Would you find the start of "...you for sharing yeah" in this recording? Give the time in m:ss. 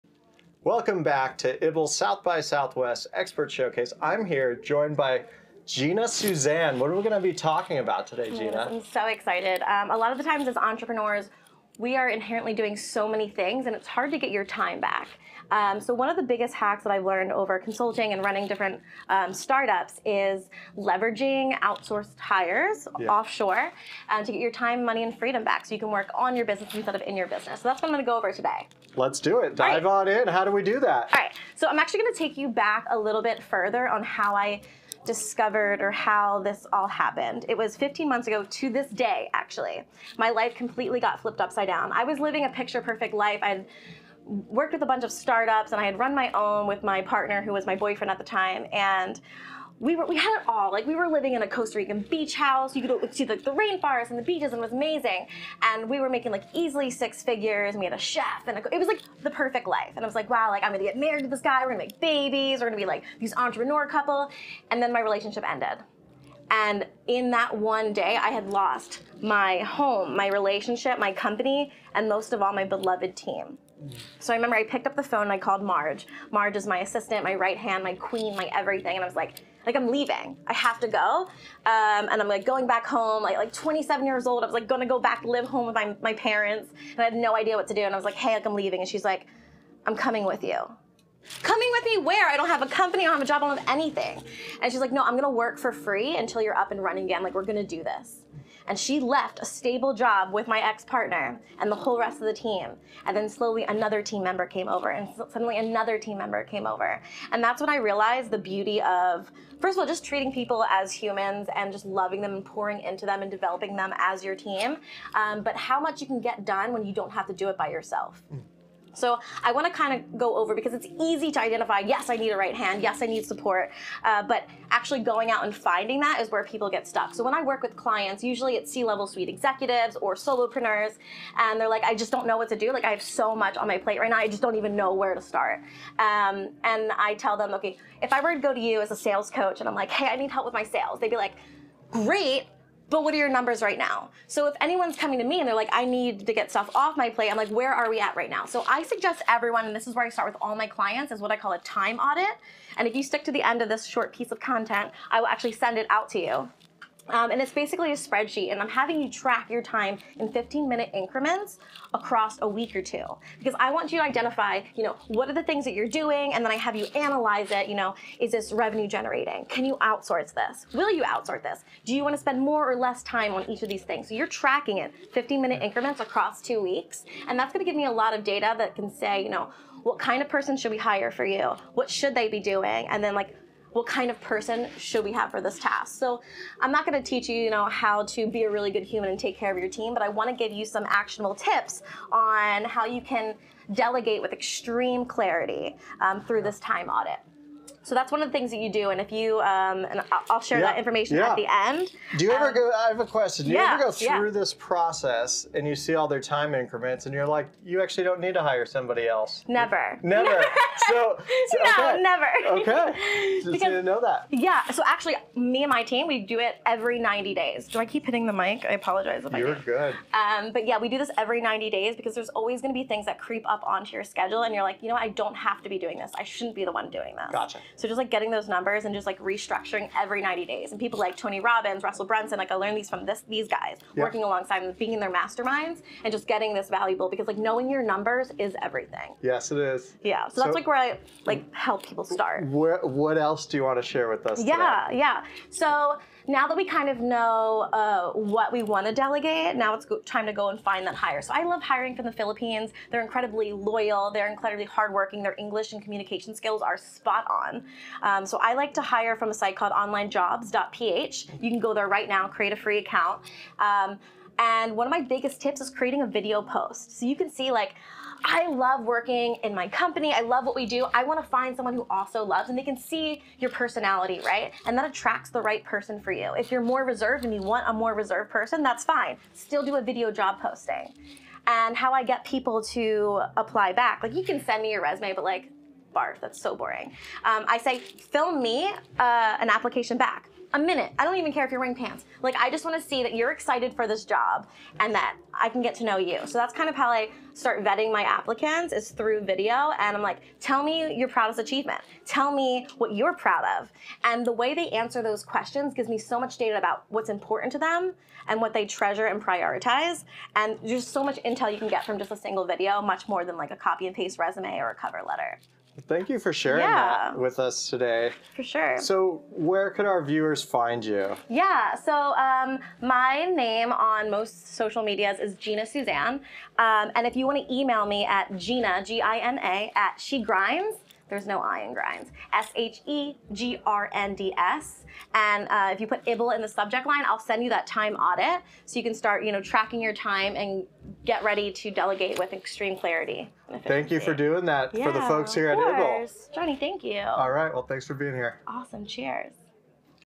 5:16.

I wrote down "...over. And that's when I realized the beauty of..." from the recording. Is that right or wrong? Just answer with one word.
right.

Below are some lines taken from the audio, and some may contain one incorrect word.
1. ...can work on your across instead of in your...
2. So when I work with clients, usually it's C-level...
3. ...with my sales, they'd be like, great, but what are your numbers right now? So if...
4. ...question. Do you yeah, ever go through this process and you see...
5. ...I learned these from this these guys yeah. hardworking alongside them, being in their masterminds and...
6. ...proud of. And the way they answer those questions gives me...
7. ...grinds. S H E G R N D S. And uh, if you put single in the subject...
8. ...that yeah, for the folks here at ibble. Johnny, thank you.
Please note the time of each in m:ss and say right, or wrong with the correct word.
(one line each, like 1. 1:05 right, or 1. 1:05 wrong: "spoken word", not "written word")
1. 0:25 wrong: "business", not "across"
2. 2:07 right
3. 2:20 right
4. 3:23 right
5. 3:52 wrong: "working", not "hardworking"
6. 5:03 right
7. 5:31 wrong: "ibble", not "single"
8. 5:44 right.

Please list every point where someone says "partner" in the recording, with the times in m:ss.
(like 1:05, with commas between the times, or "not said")
0:47, 1:40.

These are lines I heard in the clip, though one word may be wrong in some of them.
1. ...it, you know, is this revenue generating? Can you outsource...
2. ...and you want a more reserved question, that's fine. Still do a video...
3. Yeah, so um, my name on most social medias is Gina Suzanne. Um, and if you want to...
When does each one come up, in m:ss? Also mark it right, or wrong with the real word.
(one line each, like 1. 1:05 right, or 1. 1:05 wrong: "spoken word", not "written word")
1. 2:47 right
2. 4:37 wrong: "person", not "question"
3. 5:21 right.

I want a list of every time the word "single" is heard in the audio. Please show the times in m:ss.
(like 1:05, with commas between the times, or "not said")
5:12.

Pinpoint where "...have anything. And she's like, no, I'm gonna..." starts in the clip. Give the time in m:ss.
1:33.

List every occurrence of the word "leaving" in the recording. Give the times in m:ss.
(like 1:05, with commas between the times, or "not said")
1:19, 1:28.